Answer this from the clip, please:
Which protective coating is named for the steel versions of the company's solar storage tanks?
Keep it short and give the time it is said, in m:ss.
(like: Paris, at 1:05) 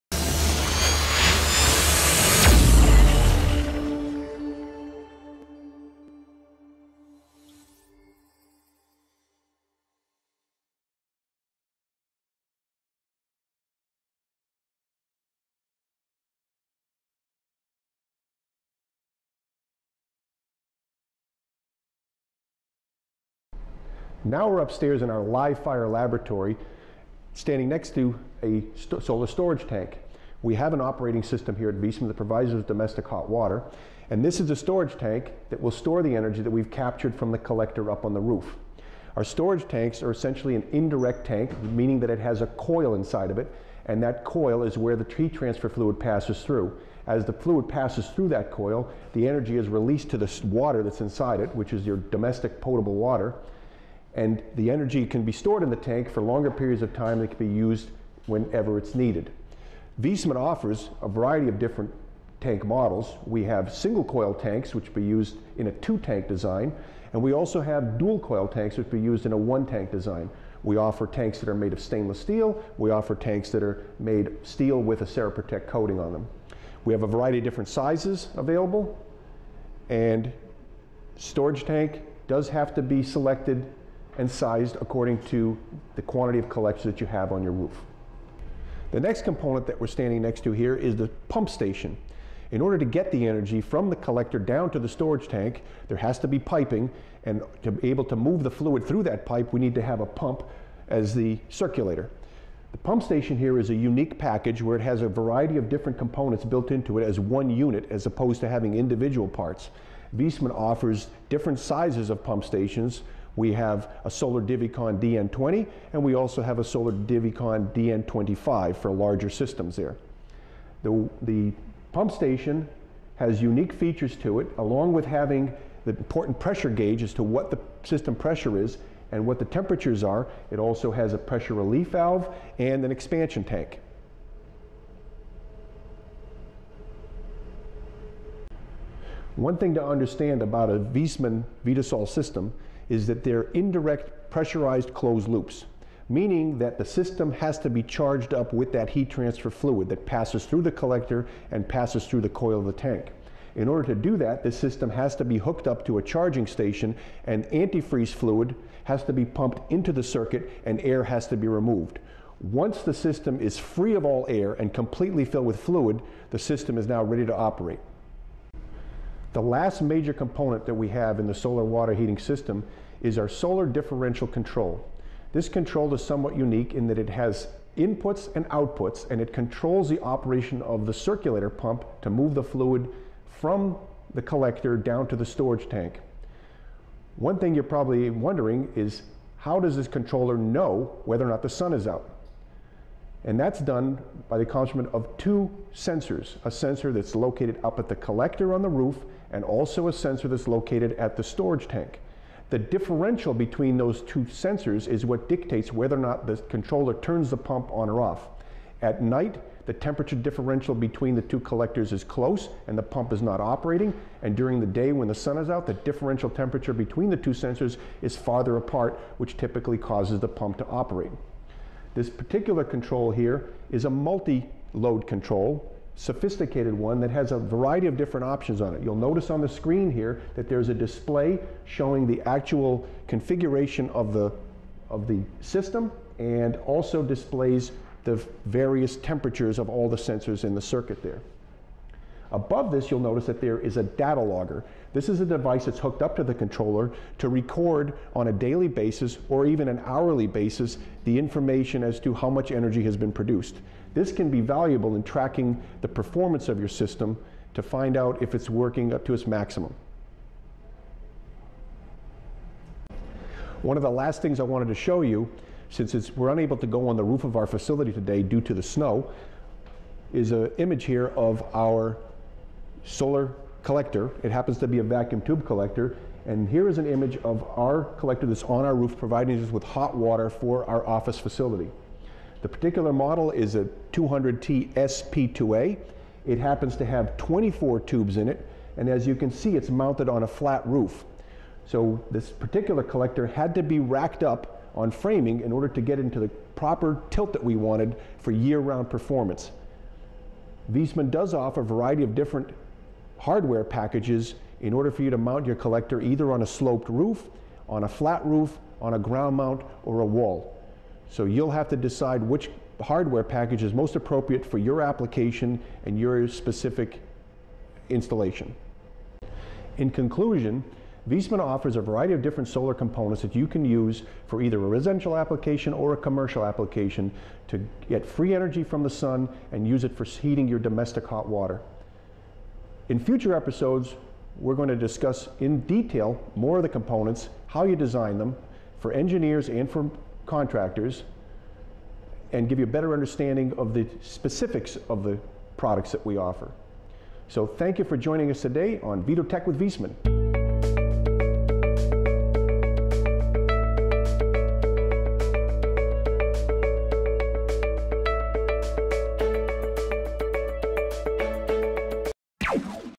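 Ceraprotect, at 1:15.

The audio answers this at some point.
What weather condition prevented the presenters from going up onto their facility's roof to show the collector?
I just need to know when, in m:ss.
4:28.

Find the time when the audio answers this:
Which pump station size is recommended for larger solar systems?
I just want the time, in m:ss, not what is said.
1:57.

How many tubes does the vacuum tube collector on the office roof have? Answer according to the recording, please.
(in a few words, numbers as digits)
24.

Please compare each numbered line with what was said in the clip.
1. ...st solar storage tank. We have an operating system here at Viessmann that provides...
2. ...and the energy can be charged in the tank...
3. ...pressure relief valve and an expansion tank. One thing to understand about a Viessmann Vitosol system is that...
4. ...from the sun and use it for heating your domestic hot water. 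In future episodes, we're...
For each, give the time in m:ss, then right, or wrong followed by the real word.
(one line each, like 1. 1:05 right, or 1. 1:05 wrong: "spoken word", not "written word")
1. 0:28 right
2. 0:54 wrong: "stored", not "charged"
3. 2:11 right
4. 5:28 right.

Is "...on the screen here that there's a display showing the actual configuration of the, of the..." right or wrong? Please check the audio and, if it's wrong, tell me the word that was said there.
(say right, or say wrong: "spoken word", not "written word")
right.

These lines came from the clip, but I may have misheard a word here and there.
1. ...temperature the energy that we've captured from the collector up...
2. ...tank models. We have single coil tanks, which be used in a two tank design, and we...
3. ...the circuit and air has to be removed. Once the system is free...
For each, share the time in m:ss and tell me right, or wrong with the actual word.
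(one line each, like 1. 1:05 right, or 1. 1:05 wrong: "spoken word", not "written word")
1. 0:35 wrong: "store", not "temperature"
2. 1:02 right
3. 2:39 right.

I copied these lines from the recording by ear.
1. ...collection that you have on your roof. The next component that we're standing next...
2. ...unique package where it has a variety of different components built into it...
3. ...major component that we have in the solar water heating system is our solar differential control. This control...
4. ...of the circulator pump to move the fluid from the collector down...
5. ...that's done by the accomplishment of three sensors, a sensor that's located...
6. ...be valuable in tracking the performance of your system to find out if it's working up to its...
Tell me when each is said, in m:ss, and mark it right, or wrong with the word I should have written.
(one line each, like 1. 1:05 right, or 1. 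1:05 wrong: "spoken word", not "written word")
1. 1:26 right
2. 1:43 right
3. 2:49 right
4. 3:00 right
5. 3:13 wrong: "two", not "three"
6. 4:14 right.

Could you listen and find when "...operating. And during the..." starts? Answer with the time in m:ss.
3:33.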